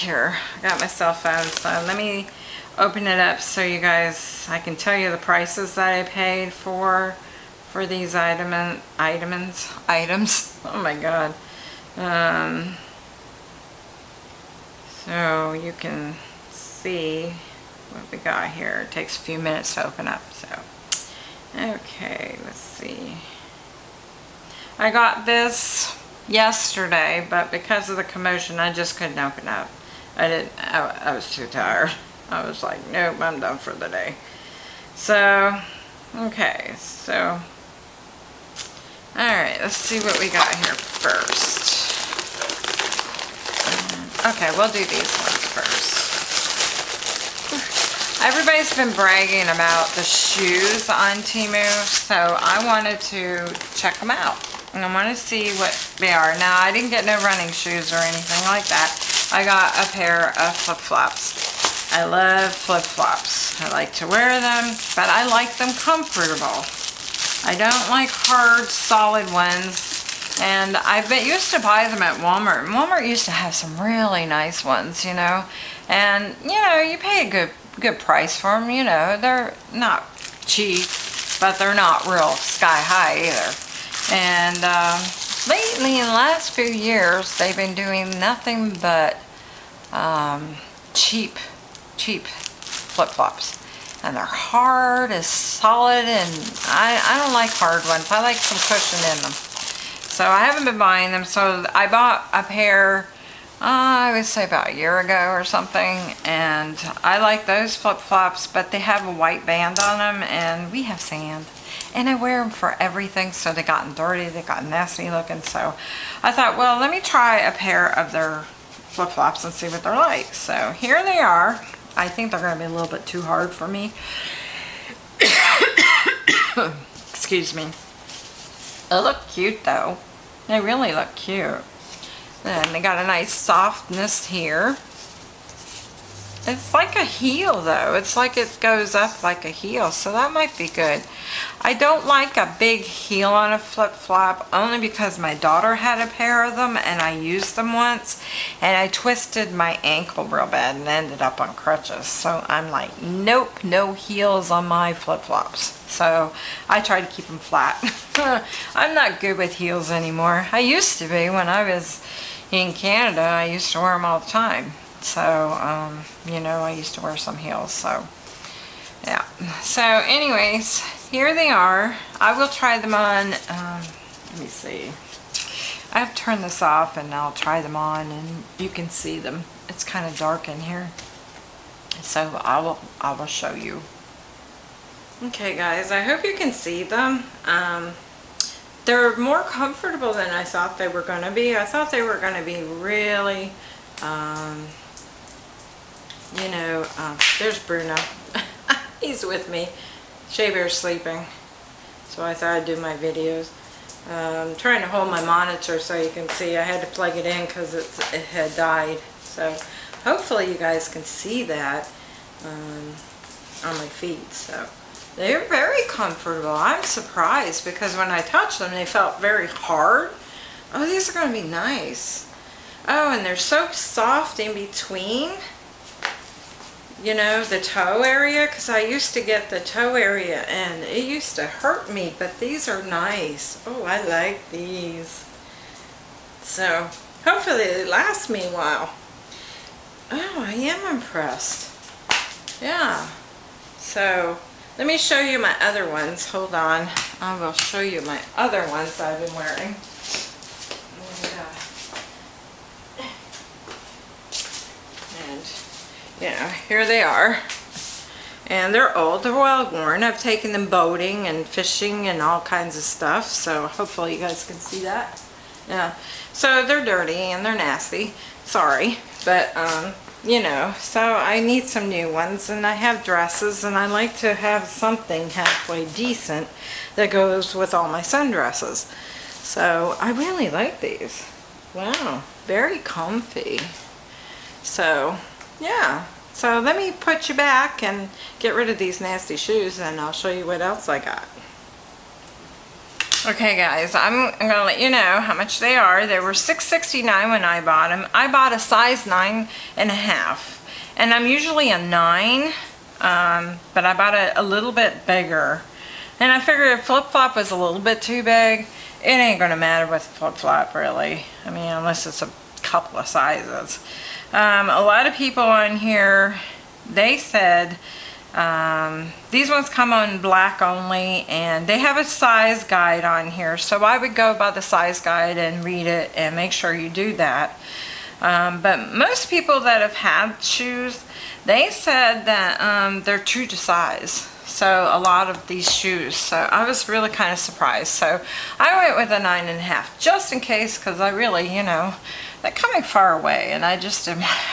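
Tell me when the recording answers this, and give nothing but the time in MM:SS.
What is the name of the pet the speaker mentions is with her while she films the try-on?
03:17.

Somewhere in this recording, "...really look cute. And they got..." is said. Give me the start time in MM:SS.
02:10.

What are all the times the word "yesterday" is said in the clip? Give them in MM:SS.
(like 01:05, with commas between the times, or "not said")
00:26.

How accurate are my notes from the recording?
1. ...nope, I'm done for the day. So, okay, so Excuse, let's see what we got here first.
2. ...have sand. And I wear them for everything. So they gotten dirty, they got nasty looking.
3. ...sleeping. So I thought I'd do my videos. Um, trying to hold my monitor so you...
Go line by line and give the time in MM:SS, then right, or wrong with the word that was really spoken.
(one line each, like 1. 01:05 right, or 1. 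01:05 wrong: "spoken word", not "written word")
1. 00:32 wrong: "Alright", not "Excuse"
2. 01:50 right
3. 03:20 right.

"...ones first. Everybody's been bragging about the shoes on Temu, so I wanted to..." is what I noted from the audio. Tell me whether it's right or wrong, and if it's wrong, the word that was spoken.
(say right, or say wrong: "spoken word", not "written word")
right.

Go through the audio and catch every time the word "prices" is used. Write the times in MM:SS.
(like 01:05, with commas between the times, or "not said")
00:05, 01:17.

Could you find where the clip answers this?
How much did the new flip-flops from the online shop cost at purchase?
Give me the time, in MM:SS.
04:56.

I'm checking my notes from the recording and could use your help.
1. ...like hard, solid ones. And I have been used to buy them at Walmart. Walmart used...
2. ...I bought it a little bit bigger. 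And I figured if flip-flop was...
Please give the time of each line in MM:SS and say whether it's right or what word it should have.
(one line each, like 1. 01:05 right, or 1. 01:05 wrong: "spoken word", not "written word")
1. 01:07 right
2. 05:03 right.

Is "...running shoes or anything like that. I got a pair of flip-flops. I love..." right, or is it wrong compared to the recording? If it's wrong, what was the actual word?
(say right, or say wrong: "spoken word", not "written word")
right.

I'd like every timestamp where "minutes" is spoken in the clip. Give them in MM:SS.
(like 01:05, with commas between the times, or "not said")
00:19.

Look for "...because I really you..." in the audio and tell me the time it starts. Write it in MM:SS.
05:40.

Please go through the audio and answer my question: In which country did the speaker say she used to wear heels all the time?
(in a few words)
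Canada.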